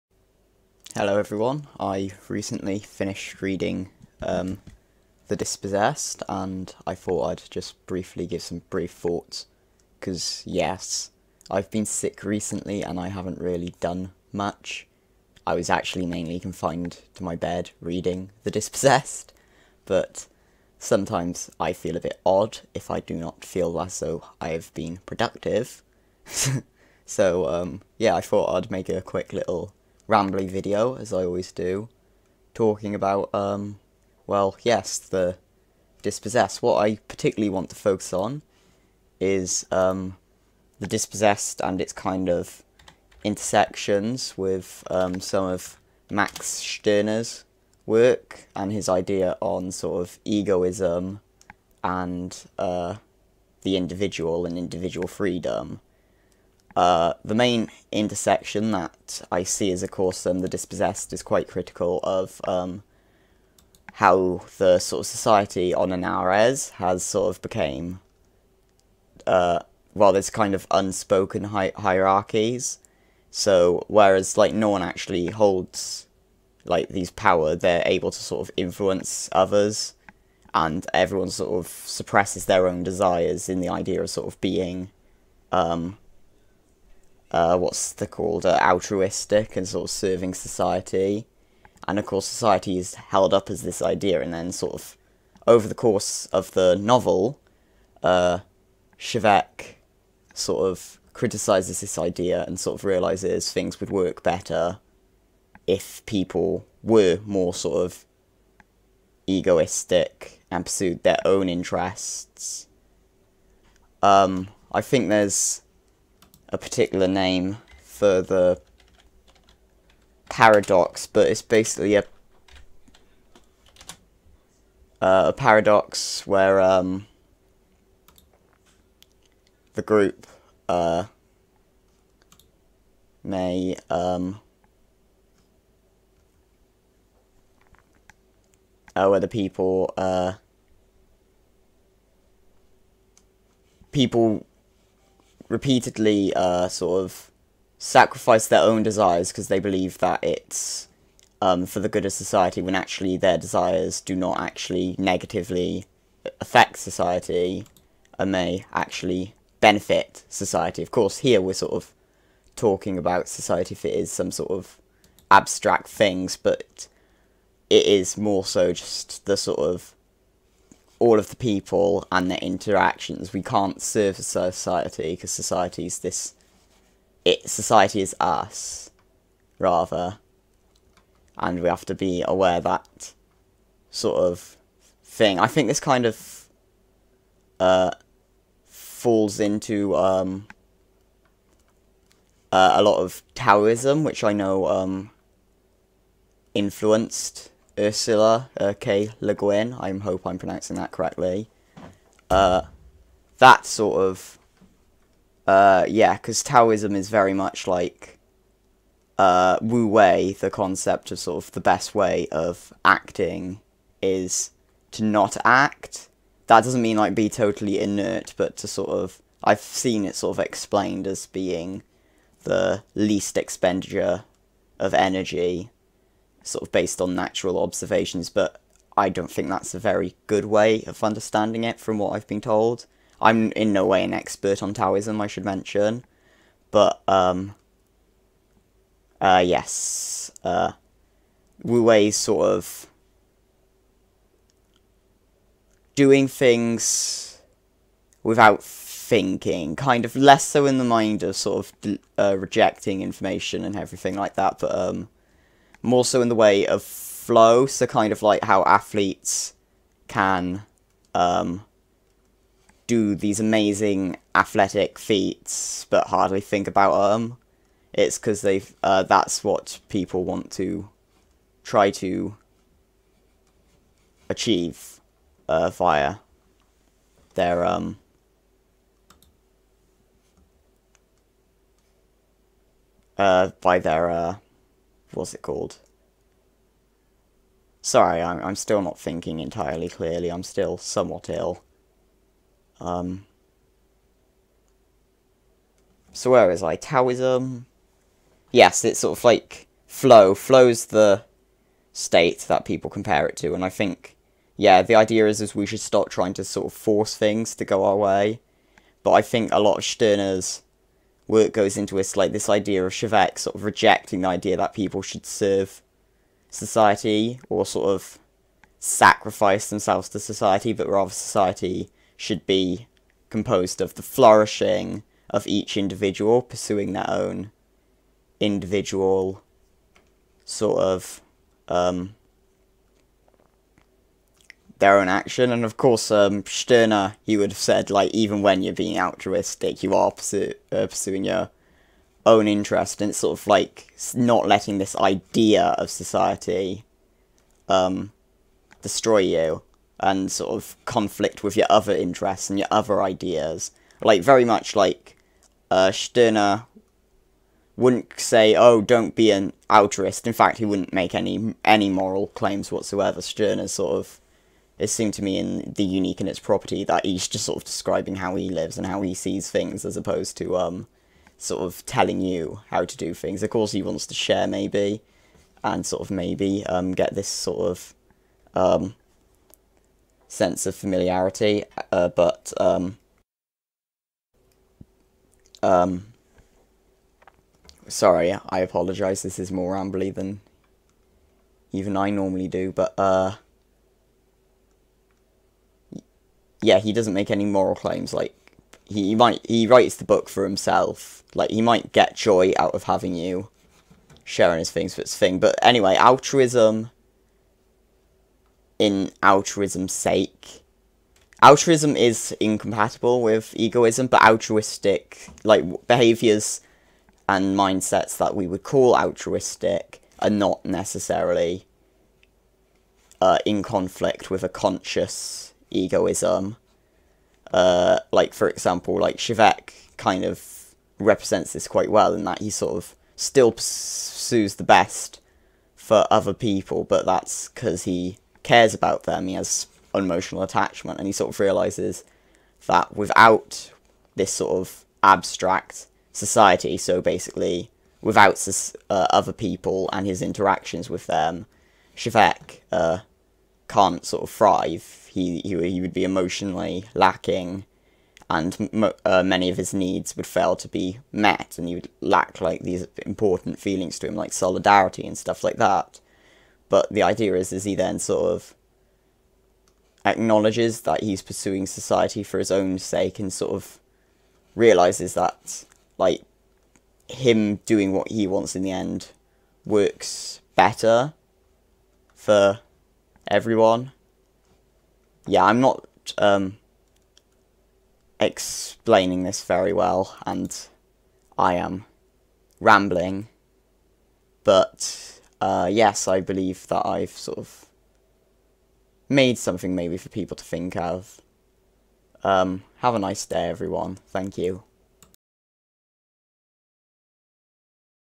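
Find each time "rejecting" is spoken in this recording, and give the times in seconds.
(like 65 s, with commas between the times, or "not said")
252 s, 313 s.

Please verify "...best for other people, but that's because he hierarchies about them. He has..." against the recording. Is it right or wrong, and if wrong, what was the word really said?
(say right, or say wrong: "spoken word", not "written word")
wrong: "cares", not "hierarchies".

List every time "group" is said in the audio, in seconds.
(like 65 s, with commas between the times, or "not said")
129 s.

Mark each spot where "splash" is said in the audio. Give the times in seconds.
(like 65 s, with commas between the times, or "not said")
not said.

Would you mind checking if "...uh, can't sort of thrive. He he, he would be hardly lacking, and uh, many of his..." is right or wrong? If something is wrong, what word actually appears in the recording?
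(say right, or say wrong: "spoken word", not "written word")
wrong: "emotionally", not "hardly".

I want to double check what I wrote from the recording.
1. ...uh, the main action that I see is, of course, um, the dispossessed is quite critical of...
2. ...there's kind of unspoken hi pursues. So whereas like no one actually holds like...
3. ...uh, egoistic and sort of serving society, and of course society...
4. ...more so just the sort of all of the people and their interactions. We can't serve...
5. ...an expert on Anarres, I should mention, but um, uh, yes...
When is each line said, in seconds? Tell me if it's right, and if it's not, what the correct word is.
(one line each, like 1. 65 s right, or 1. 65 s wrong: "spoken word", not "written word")
1. 56 s wrong: "intersection", not "action"
2. 70 s wrong: "hierarchies", not "pursues"
3. 88 s wrong: "altruistic", not "egoistic"
4. 168 s right
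5. 234 s wrong: "Taoism", not "Anarres".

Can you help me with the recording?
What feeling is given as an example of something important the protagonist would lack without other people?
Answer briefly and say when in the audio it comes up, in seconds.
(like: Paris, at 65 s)
Solidarity, at 464 s.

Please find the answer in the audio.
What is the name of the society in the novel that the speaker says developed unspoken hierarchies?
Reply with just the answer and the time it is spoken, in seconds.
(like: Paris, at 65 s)
Anarres, at 65 s.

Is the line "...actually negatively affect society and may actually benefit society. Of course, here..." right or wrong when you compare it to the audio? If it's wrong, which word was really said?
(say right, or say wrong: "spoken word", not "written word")
right.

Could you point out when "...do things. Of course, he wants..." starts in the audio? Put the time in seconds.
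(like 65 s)
372 s.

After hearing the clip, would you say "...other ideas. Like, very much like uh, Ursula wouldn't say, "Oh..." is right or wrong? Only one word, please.
wrong.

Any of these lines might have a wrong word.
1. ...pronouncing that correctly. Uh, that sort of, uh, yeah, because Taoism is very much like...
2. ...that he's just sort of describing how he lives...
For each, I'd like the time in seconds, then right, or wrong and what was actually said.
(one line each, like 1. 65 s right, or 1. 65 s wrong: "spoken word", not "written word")
1. 200 s right
2. 366 s right.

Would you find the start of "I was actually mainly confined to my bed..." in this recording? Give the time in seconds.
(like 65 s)
15 s.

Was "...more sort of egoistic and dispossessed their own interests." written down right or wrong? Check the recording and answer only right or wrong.
wrong.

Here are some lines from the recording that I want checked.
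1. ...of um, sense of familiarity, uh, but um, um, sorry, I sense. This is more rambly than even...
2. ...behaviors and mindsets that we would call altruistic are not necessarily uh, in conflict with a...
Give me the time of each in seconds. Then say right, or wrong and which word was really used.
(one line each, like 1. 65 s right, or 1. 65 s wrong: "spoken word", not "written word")
1. 377 s wrong: "apologise", not "sense"
2. 415 s right.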